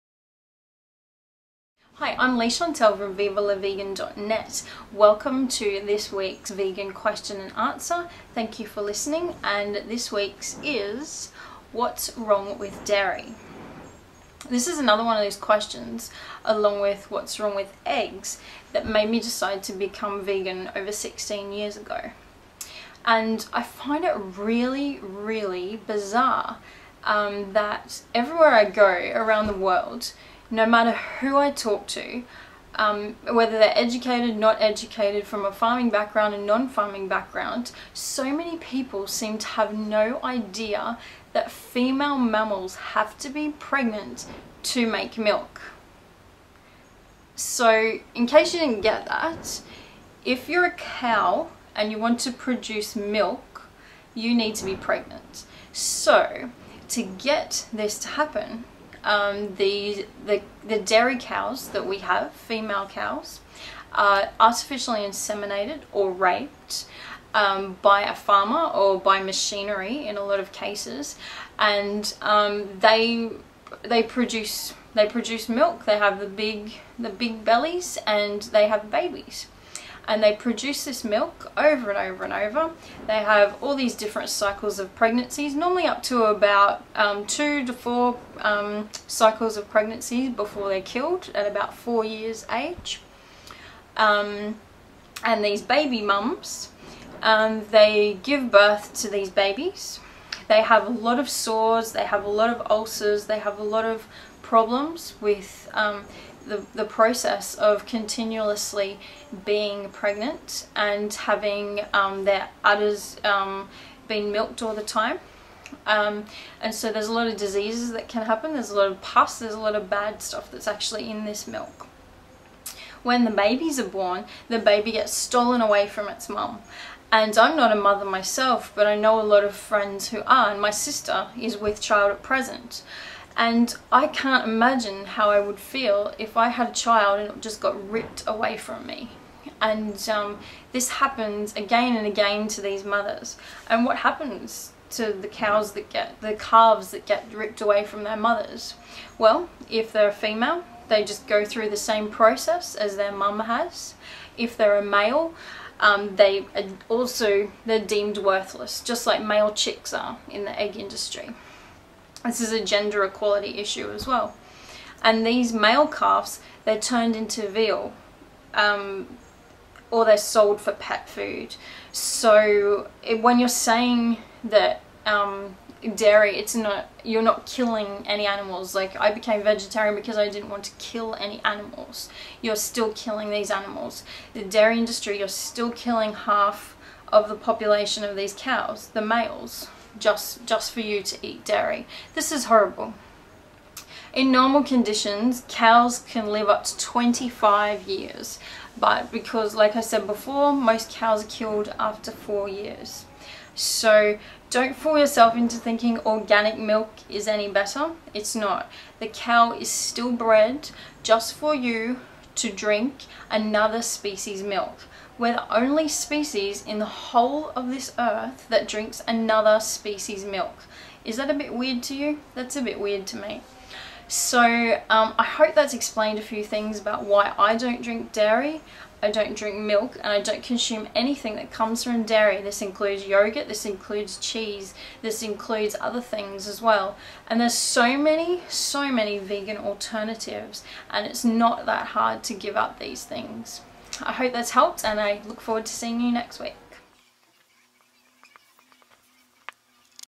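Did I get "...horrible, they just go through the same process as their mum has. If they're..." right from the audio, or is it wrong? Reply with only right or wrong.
wrong.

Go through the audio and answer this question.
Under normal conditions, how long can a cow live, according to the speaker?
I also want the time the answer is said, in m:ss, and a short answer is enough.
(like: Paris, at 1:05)
25 years, at 3:16.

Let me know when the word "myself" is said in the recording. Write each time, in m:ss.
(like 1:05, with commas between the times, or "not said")
2:08.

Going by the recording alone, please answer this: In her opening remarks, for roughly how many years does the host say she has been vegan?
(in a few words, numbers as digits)
16 years.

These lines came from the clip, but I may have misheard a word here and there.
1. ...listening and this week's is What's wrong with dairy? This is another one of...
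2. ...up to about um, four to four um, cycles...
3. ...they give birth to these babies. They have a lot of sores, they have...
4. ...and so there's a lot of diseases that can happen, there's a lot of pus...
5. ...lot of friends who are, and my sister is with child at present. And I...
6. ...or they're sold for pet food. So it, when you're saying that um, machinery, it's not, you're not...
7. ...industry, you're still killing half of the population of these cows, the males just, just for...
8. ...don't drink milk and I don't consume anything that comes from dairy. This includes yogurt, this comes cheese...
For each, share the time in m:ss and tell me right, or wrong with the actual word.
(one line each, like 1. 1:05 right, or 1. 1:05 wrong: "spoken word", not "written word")
1. 0:08 right
2. 1:25 wrong: "two", not "four"
3. 1:37 right
4. 1:56 right
5. 2:09 right
6. 2:49 wrong: "dairy", not "machinery"
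7. 3:04 right
8. 3:49 wrong: "includes", not "comes".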